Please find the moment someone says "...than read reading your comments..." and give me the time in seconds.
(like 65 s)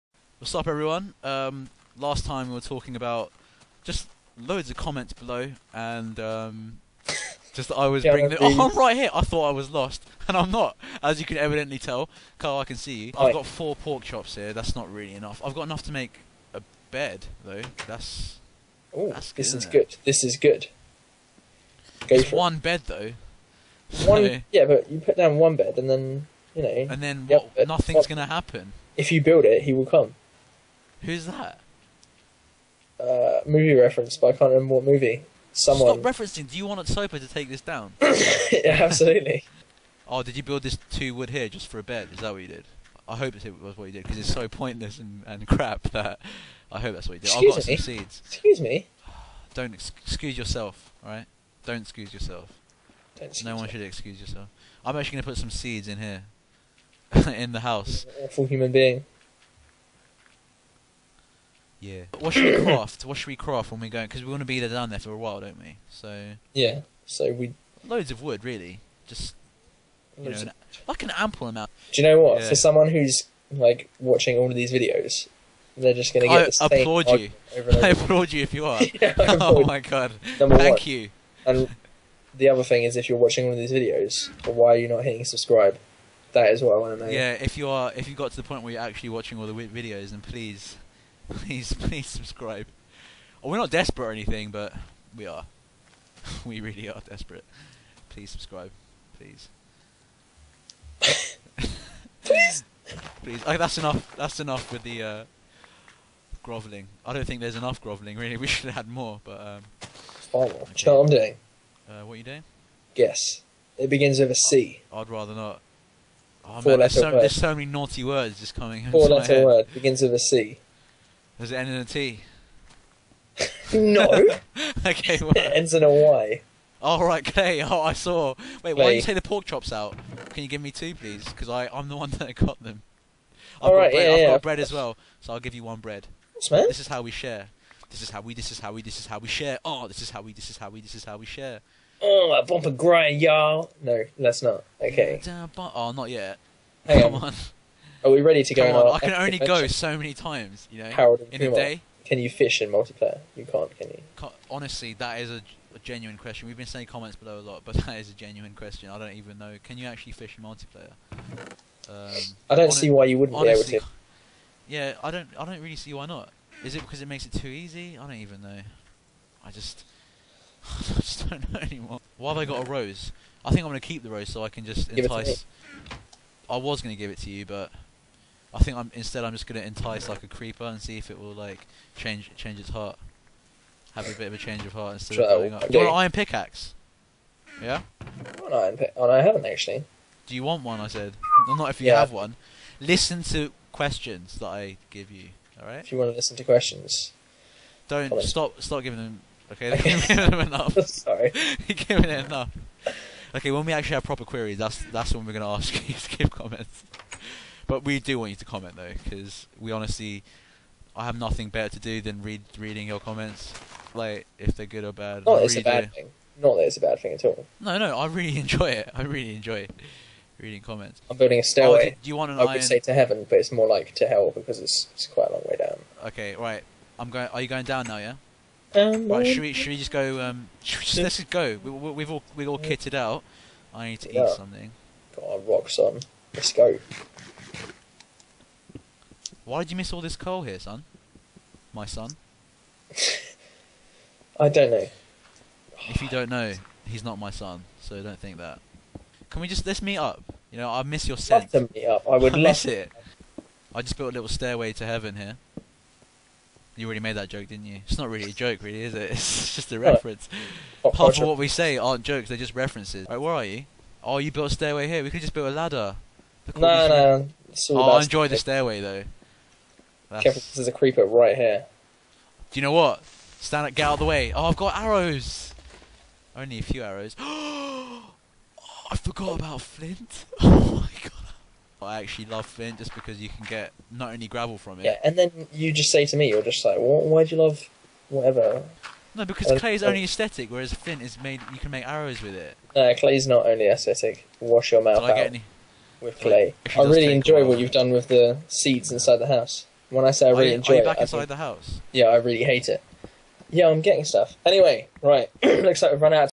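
212 s.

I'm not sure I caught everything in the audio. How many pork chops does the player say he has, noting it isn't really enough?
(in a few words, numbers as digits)
4.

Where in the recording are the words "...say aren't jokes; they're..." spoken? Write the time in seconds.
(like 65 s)
261 s.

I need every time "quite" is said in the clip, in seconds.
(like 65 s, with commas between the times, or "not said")
225 s.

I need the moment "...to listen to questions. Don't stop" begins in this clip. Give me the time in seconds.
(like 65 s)
196 s.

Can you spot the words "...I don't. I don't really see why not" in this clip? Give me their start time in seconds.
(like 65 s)
165 s.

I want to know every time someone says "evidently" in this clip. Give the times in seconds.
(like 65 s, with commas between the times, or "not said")
11 s.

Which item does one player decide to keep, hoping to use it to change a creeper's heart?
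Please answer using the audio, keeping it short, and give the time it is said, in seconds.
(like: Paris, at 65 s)
a rose, at 172 s.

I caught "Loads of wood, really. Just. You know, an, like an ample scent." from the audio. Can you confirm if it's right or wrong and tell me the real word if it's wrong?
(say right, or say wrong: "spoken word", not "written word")
wrong: "amount", not "scent".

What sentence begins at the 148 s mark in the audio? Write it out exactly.
on, on I can only go so many times, you know, Harold in Kumar, a day.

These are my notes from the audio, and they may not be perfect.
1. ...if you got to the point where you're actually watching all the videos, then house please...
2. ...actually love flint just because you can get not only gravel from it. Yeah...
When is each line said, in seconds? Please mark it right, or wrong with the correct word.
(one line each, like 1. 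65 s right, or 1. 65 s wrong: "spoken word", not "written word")
1. 87 s wrong: "please", not "house"
2. 282 s right.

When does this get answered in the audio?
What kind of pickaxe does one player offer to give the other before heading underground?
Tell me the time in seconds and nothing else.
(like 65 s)
185 s.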